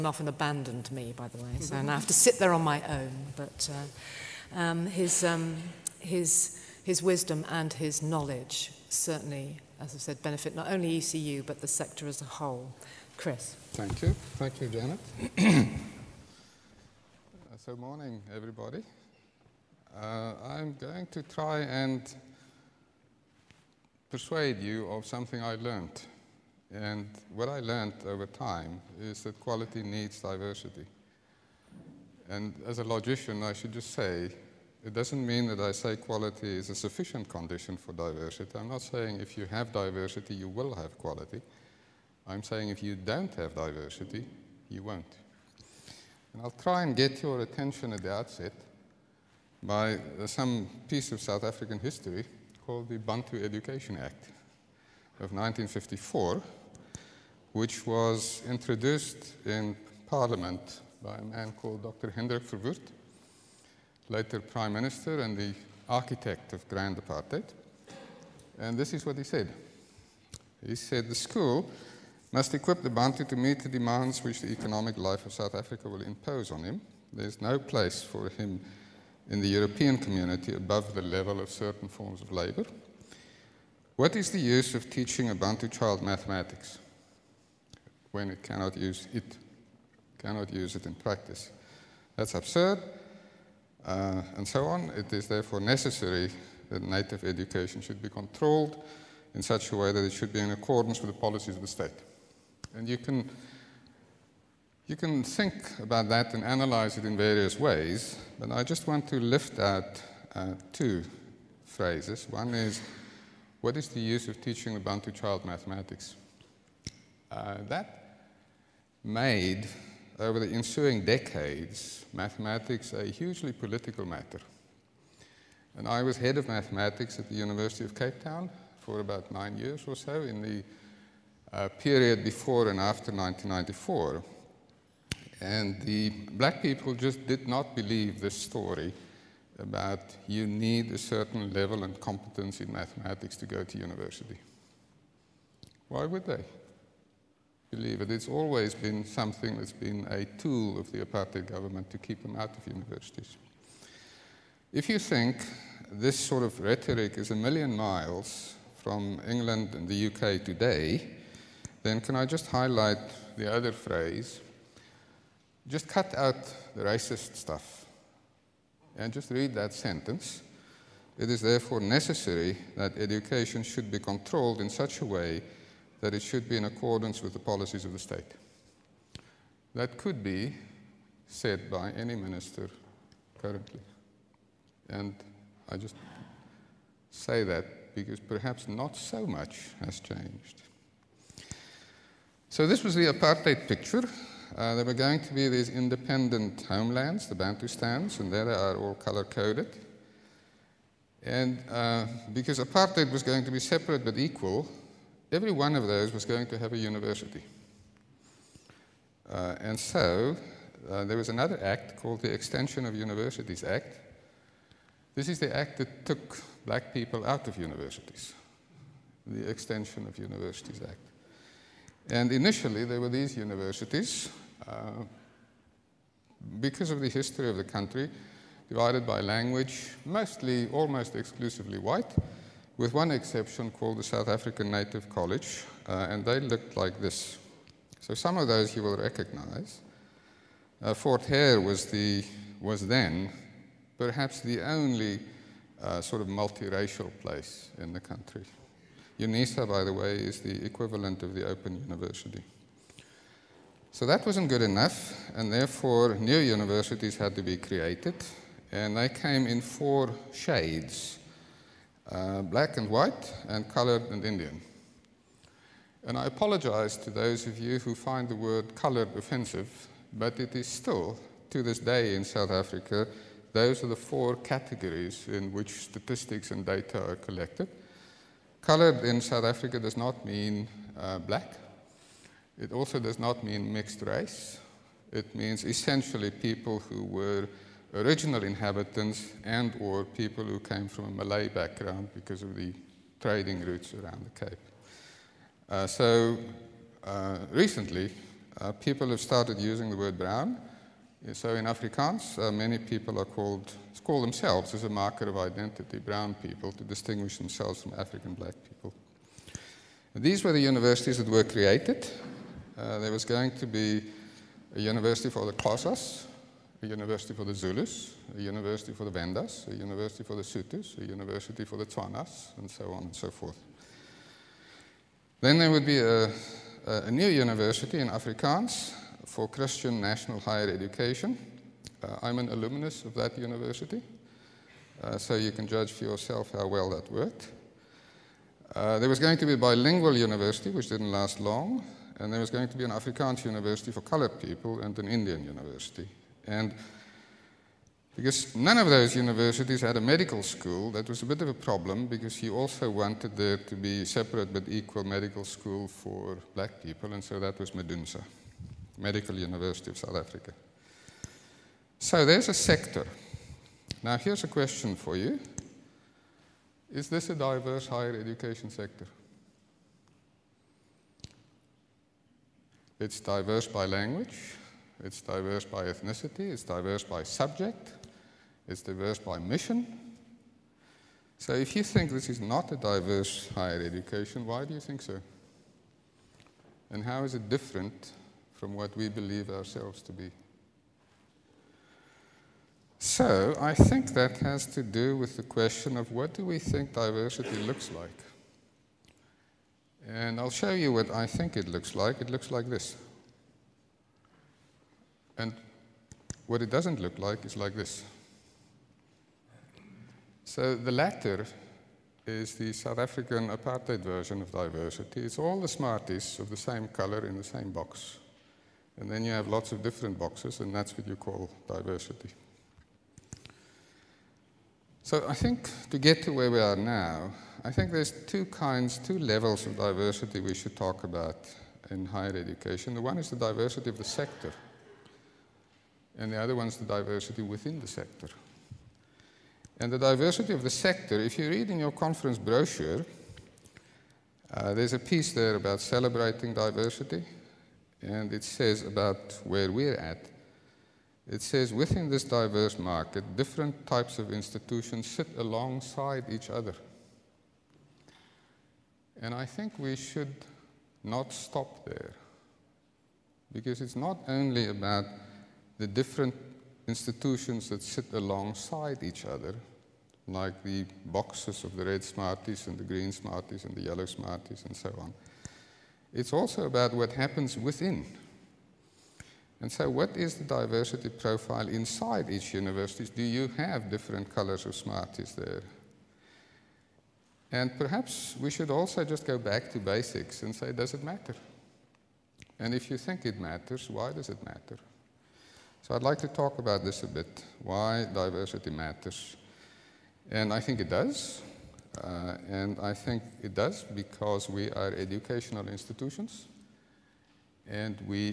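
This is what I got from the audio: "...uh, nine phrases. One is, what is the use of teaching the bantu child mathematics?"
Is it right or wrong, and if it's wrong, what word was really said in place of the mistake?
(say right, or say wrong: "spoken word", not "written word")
wrong: "two", not "nine".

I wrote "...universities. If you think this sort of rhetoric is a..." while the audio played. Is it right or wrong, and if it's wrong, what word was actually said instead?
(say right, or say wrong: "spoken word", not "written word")
right.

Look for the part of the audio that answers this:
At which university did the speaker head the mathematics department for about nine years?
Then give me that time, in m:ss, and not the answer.
2:07.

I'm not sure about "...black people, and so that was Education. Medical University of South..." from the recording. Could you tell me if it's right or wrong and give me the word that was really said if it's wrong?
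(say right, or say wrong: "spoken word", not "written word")
wrong: "Medunsa", not "Education".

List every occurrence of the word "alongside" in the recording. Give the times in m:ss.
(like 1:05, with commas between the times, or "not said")
7:35, 7:48.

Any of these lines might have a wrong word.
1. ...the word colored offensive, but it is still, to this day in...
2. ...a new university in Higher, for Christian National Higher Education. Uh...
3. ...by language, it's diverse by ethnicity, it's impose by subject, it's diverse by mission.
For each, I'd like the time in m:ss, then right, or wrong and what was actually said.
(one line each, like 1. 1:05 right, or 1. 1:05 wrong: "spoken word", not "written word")
1. 4:28 right
2. 5:26 wrong: "Afrikaans", not "Higher"
3. 6:13 wrong: "diverse", not "impose".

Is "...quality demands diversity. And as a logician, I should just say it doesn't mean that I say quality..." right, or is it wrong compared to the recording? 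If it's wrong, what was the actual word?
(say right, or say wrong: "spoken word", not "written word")
wrong: "needs", not "demands".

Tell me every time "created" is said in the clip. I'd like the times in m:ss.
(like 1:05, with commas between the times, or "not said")
4:17, 5:11.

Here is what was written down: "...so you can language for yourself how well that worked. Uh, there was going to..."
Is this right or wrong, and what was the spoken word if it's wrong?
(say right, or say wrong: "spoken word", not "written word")
wrong: "judge", not "language".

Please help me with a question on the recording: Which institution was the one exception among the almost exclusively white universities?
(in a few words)
South African Native College.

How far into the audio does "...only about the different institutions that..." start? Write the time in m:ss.
7:44.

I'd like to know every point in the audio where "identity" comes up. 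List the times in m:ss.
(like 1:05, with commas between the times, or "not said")
5:05.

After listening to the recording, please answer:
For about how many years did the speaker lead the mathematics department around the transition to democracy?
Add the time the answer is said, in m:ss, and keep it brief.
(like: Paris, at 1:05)
9, at 2:09.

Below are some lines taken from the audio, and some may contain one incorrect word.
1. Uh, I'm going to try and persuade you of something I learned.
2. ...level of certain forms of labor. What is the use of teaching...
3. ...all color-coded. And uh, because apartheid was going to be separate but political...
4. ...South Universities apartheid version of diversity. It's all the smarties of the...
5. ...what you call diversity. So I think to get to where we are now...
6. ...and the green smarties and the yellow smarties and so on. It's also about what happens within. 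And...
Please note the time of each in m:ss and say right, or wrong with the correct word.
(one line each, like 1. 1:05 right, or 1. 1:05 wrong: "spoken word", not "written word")
1. 0:20 right
2. 1:21 right
3. 3:18 wrong: "equal", not "political"
4. 6:52 wrong: "African", not "Universities"
5. 7:00 right
6. 7:52 right.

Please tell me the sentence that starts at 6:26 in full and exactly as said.
And how is it different from what we believe ourselves to be.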